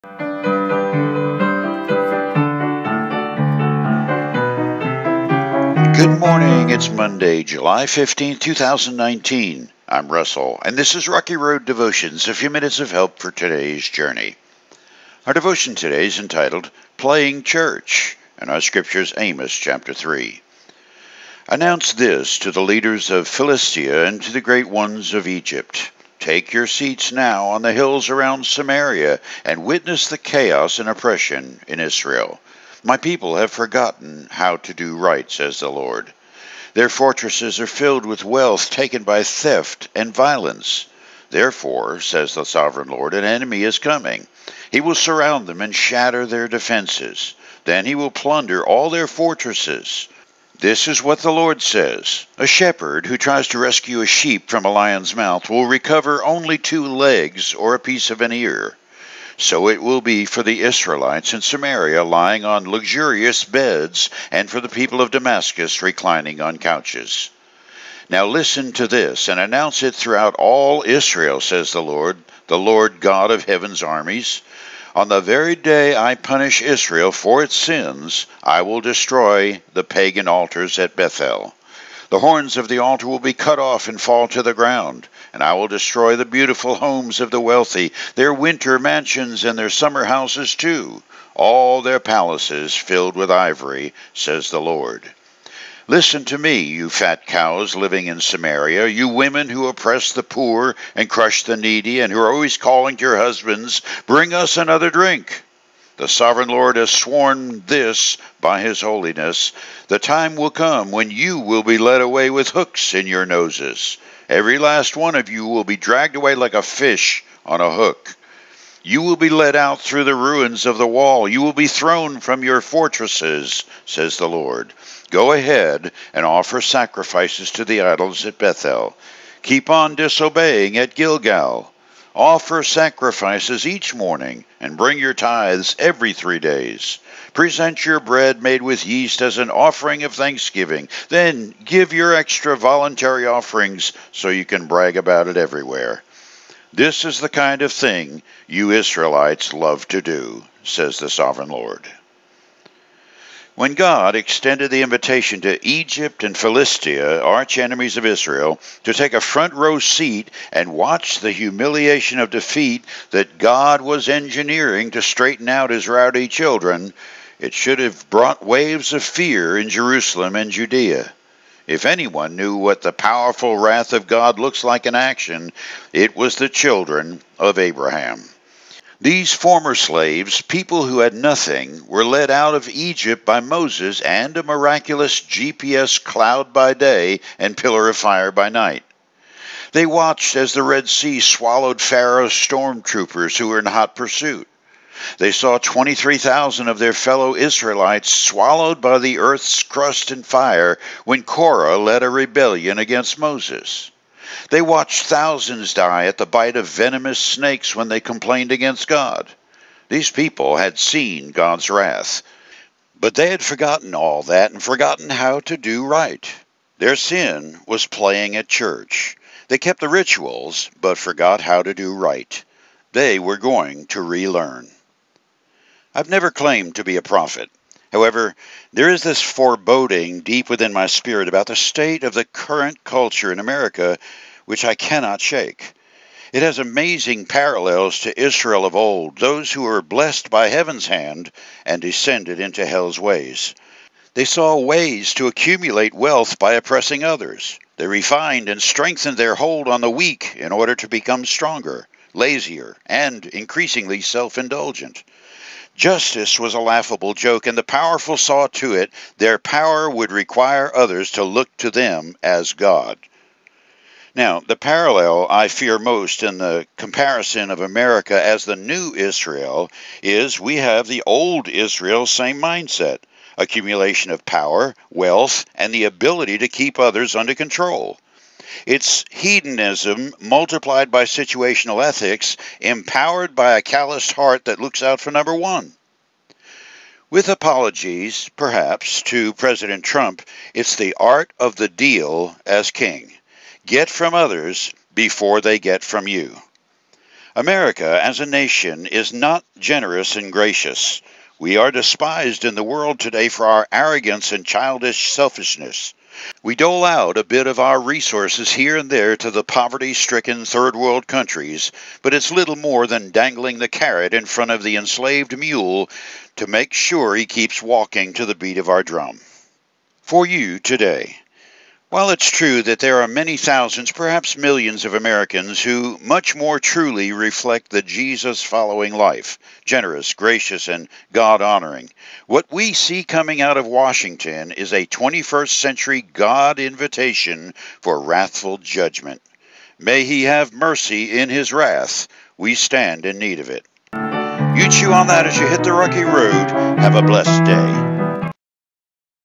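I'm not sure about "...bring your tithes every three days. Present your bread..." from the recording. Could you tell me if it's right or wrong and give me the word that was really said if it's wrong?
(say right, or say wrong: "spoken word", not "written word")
right.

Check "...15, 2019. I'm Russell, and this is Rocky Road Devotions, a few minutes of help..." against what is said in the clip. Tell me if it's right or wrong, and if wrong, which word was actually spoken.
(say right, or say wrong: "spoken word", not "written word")
right.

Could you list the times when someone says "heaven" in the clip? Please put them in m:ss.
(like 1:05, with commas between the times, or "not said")
1:13, 4:00.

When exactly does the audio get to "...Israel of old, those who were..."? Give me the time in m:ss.
3:58.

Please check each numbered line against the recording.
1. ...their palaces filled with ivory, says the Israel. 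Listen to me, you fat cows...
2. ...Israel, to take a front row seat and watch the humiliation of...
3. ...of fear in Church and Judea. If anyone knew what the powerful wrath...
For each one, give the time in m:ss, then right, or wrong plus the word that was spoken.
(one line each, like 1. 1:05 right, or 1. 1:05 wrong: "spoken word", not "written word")
1. 1:31 wrong: "Lord", not "Israel"
2. 2:38 right
3. 2:48 wrong: "Jerusalem", not "Church".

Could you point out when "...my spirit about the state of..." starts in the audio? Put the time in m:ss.
3:50.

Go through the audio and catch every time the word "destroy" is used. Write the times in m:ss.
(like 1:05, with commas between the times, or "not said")
1:18, 1:25.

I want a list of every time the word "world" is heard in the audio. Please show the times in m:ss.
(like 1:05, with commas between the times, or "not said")
5:02, 5:10.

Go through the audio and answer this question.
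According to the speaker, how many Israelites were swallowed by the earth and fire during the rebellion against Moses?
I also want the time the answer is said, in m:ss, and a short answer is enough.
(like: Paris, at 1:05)
23,000, at 3:15.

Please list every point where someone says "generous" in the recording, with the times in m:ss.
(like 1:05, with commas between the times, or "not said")
4:59, 5:29.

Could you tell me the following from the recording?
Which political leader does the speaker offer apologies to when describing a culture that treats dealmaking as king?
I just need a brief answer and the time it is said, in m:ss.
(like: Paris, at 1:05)
President Trump, at 4:49.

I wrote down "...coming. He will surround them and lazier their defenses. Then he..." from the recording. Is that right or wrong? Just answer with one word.
wrong.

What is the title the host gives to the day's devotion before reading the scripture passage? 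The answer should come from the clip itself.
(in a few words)
Playing Church.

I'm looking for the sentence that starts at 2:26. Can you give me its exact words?
This is the kind of thing you Israelites love to do, says the Sovereign Lord.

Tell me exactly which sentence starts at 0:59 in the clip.
So it will be for the Israelites in Samaria lying on luxurious beds, and for the people of Damascus reclining on couches.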